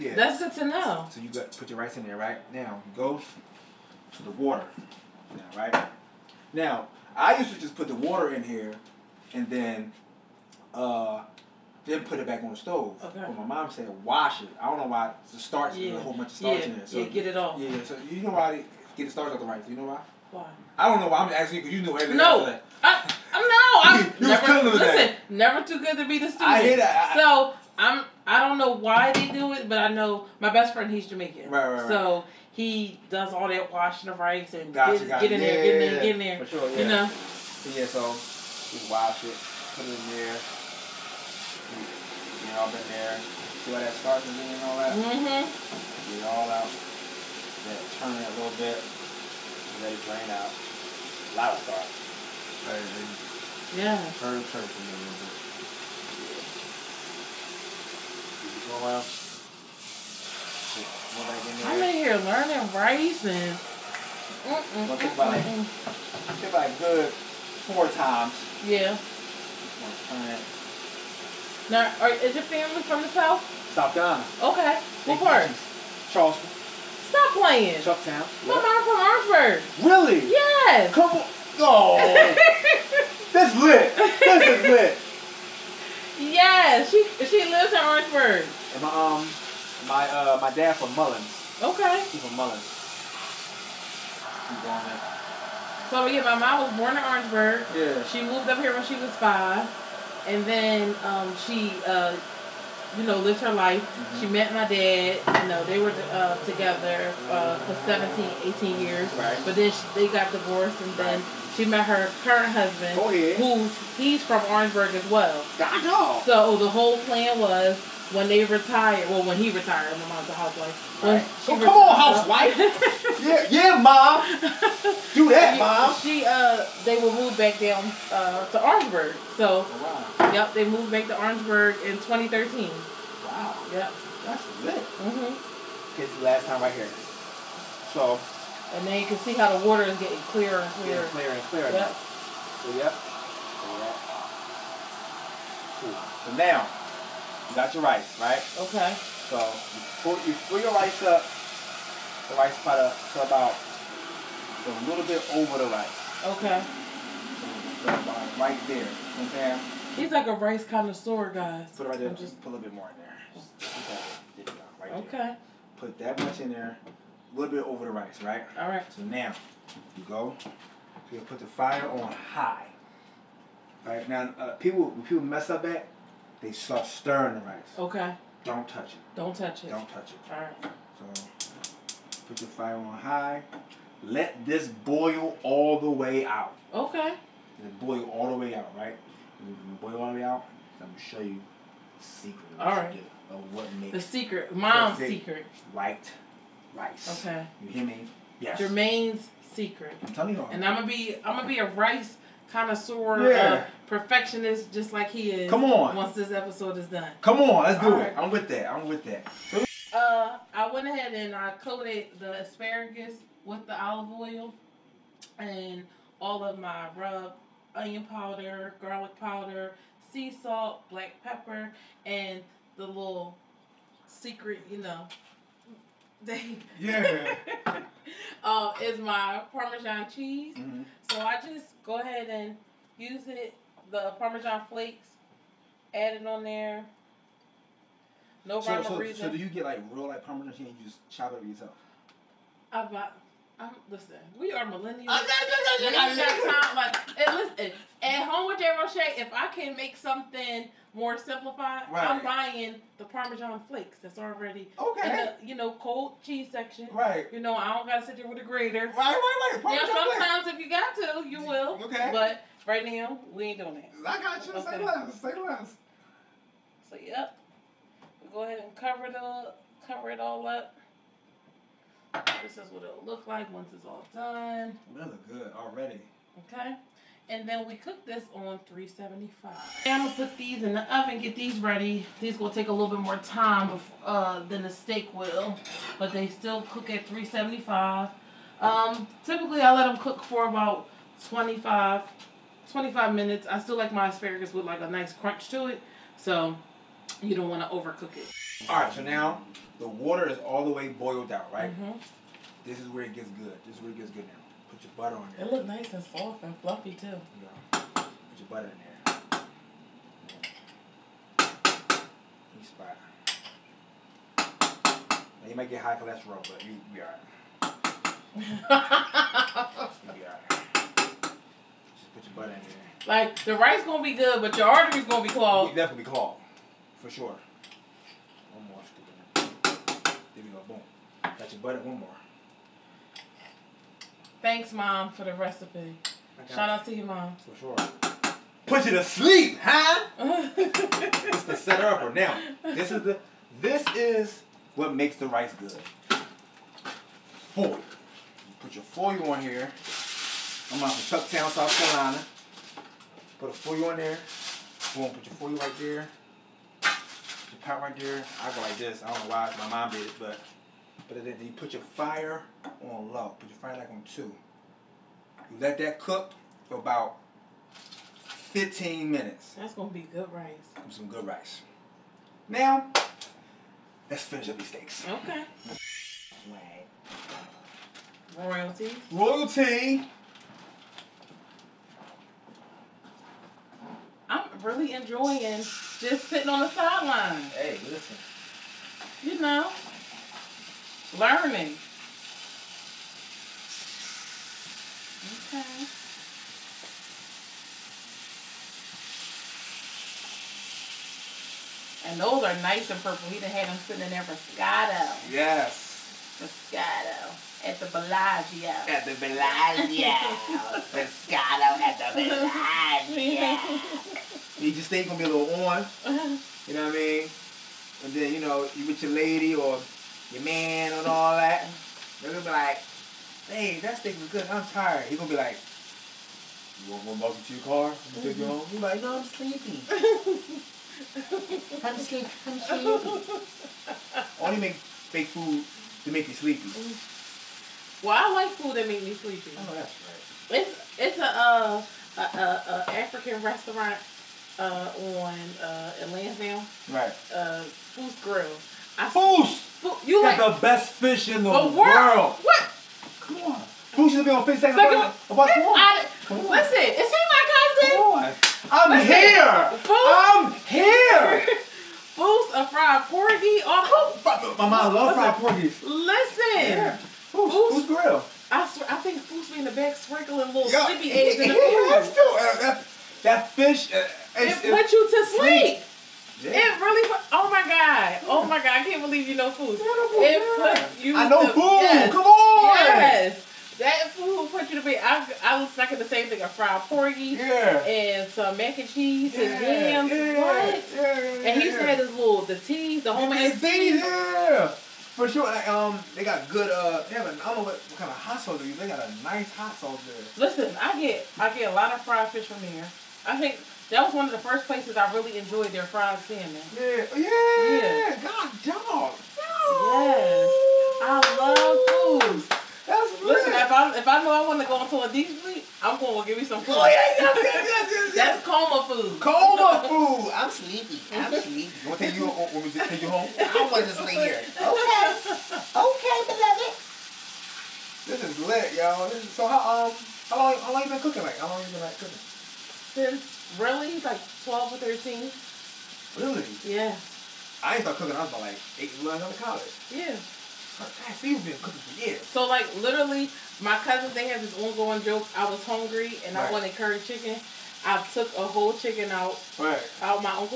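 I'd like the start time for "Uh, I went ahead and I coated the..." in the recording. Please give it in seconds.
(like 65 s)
209 s.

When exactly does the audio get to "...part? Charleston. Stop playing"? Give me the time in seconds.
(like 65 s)
75 s.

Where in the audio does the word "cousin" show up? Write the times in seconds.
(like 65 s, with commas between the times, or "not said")
457 s, 543 s.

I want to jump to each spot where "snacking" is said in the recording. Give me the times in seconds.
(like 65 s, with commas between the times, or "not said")
485 s.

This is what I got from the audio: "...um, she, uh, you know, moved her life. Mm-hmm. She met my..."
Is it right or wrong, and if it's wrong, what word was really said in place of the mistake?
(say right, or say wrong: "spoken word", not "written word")
wrong: "lived", not "moved".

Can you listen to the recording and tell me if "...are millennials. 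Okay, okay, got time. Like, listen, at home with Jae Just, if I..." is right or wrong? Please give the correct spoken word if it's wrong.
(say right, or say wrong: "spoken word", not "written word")
wrong: "Roche", not "Just".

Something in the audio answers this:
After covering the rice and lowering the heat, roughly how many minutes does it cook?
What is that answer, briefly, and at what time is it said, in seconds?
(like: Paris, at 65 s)
15, at 368 s.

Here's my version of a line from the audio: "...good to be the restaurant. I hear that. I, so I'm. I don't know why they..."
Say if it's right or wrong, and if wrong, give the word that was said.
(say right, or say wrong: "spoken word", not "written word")
wrong: "student", not "restaurant".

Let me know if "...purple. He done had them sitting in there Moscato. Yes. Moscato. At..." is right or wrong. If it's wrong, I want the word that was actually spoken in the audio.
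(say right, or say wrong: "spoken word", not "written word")
right.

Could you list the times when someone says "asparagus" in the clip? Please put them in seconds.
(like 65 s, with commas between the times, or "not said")
212 s, 294 s.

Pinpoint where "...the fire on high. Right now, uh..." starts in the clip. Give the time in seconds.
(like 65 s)
171 s.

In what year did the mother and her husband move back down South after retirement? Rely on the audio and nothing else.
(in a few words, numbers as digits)
2013.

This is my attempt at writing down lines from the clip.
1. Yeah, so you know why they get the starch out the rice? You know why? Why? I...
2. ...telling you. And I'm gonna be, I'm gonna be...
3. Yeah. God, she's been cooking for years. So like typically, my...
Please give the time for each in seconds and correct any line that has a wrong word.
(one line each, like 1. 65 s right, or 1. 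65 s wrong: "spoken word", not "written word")
1. 17 s right
2. 200 s right
3. 539 s wrong: "literally", not "typically".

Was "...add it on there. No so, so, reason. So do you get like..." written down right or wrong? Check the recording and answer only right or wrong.
right.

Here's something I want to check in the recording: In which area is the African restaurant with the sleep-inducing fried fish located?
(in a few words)
Lansdowne.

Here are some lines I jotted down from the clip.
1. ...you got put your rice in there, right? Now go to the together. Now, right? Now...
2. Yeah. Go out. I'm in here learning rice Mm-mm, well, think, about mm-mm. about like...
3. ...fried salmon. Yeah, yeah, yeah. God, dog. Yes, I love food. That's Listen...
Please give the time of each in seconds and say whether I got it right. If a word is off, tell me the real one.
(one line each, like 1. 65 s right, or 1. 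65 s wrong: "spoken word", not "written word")
1. 1 s wrong: "water", not "together"
2. 55 s right
3. 505 s right.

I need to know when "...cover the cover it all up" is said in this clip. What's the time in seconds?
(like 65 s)
268 s.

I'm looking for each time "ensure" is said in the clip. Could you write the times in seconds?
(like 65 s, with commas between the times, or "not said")
not said.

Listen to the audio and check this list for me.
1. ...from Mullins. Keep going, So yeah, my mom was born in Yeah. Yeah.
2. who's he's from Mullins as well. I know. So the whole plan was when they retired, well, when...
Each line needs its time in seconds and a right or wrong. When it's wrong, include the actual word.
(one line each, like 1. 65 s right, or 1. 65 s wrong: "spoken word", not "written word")
1. 92 s wrong: "Orangeburg", not "Yeah"
2. 113 s wrong: "Orangeburg", not "Mullins".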